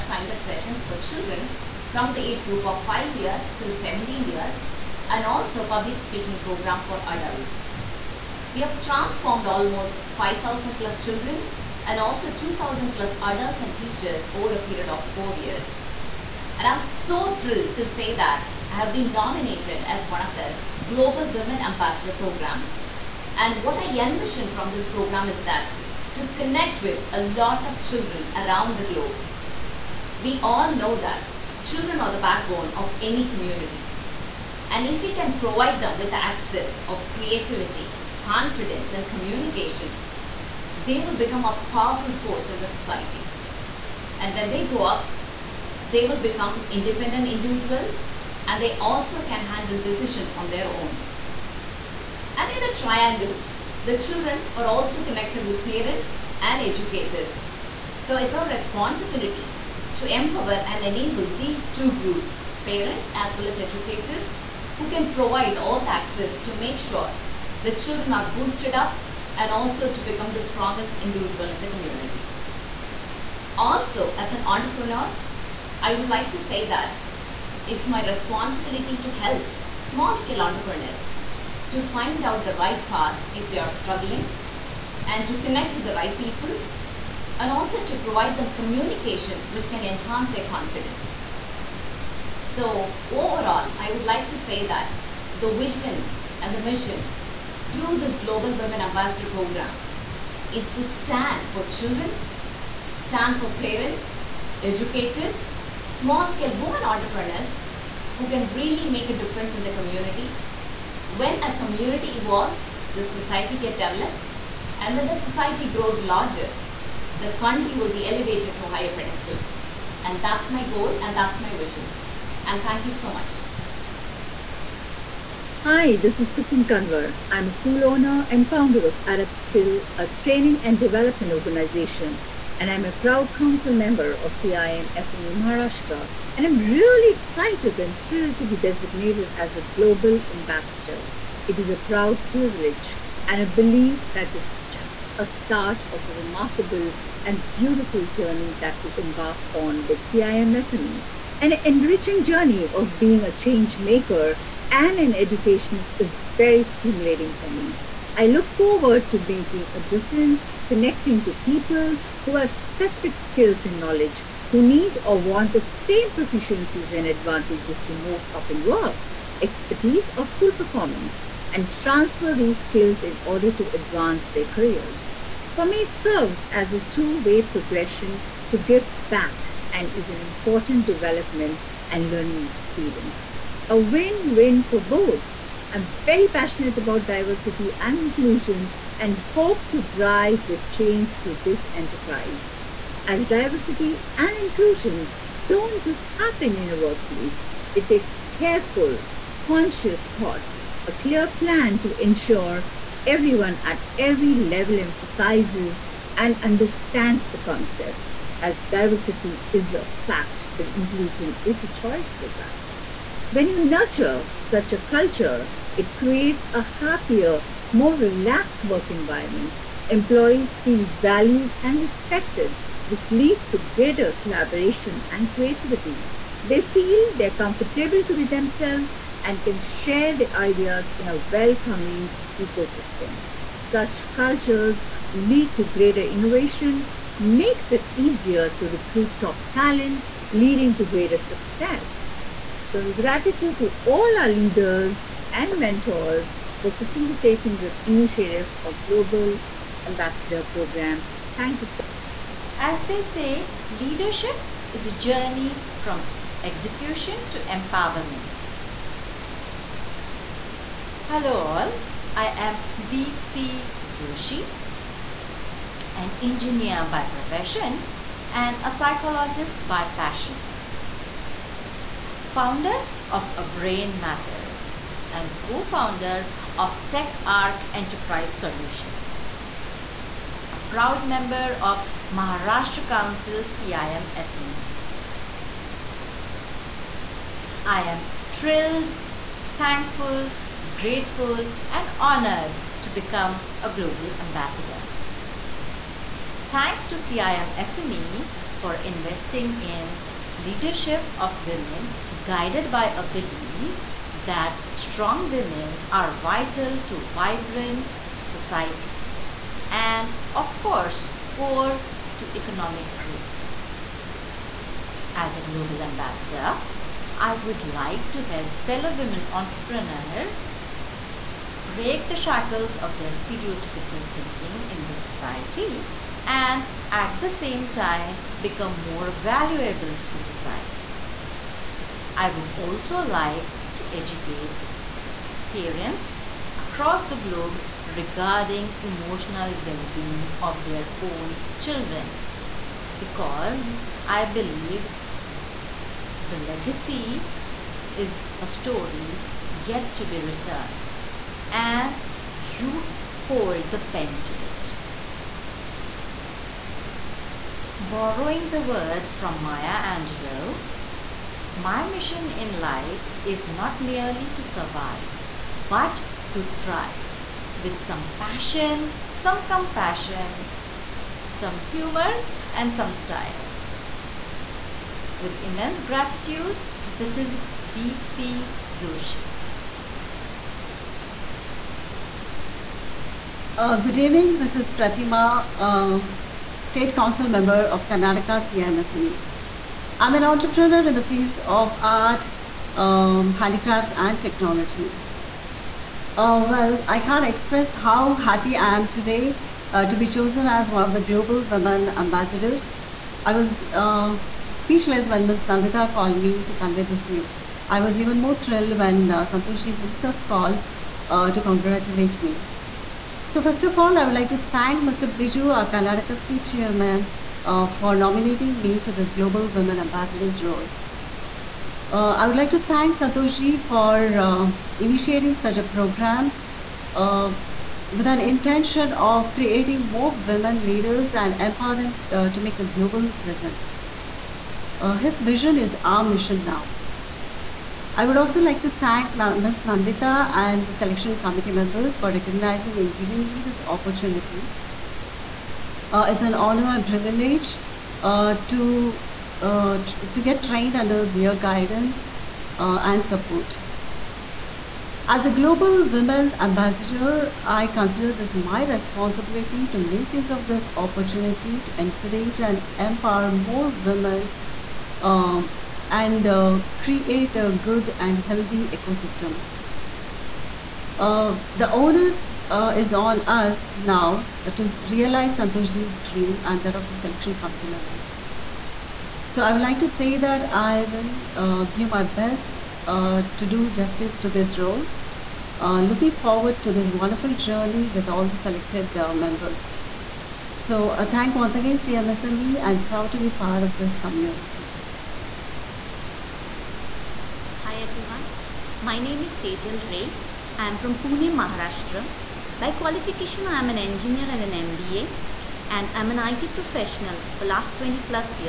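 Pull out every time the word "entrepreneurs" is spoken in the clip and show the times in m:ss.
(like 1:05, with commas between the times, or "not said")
1:14, 1:20, 1:46, 5:19, 6:30.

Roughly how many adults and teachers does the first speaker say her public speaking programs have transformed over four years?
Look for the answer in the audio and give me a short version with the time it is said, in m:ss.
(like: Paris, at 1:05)
2000+, at 0:12.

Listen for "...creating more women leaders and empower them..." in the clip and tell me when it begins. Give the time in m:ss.
7:09.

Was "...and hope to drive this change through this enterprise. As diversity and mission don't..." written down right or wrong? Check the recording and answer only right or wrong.
wrong.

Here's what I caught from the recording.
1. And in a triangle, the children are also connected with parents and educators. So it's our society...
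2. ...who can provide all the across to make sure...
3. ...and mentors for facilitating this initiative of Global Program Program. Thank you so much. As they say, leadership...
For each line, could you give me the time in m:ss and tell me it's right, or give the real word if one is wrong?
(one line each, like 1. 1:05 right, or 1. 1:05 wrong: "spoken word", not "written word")
1. 0:52 wrong: "responsibility", not "society"
2. 1:04 wrong: "access", not "across"
3. 4:05 wrong: "Ambassador", not "Program".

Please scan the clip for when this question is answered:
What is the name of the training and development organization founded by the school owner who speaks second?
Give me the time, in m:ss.
2:09.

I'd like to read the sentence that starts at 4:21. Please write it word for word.
Hello all, I am Deepthi Joshi, an engineer by profession and a psychologist by passion.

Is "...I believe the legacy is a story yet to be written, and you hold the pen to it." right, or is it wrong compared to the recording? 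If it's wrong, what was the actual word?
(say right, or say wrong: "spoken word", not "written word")
right.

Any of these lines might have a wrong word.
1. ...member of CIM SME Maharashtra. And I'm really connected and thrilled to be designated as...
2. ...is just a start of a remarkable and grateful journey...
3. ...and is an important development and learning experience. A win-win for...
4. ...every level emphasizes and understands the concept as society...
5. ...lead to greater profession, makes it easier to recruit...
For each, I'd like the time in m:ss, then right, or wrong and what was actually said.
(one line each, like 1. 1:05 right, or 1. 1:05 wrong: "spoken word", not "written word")
1. 2:13 wrong: "excited", not "connected"
2. 2:24 wrong: "beautiful", not "grateful"
3. 2:59 right
4. 3:23 wrong: "diversity", not "society"
5. 3:55 wrong: "innovation", not "profession".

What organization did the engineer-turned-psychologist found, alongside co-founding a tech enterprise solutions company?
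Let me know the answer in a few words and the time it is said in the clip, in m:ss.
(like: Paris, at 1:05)
Brain Matters, at 4:33.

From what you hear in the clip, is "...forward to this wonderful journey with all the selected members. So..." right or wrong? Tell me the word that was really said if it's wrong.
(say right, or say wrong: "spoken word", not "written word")
right.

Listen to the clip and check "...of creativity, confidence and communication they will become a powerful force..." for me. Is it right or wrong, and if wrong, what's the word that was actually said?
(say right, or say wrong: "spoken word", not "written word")
right.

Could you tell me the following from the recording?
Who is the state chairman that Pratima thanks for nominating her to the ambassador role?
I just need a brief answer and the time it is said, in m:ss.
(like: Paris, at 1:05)
Mr. Biju, at 6:54.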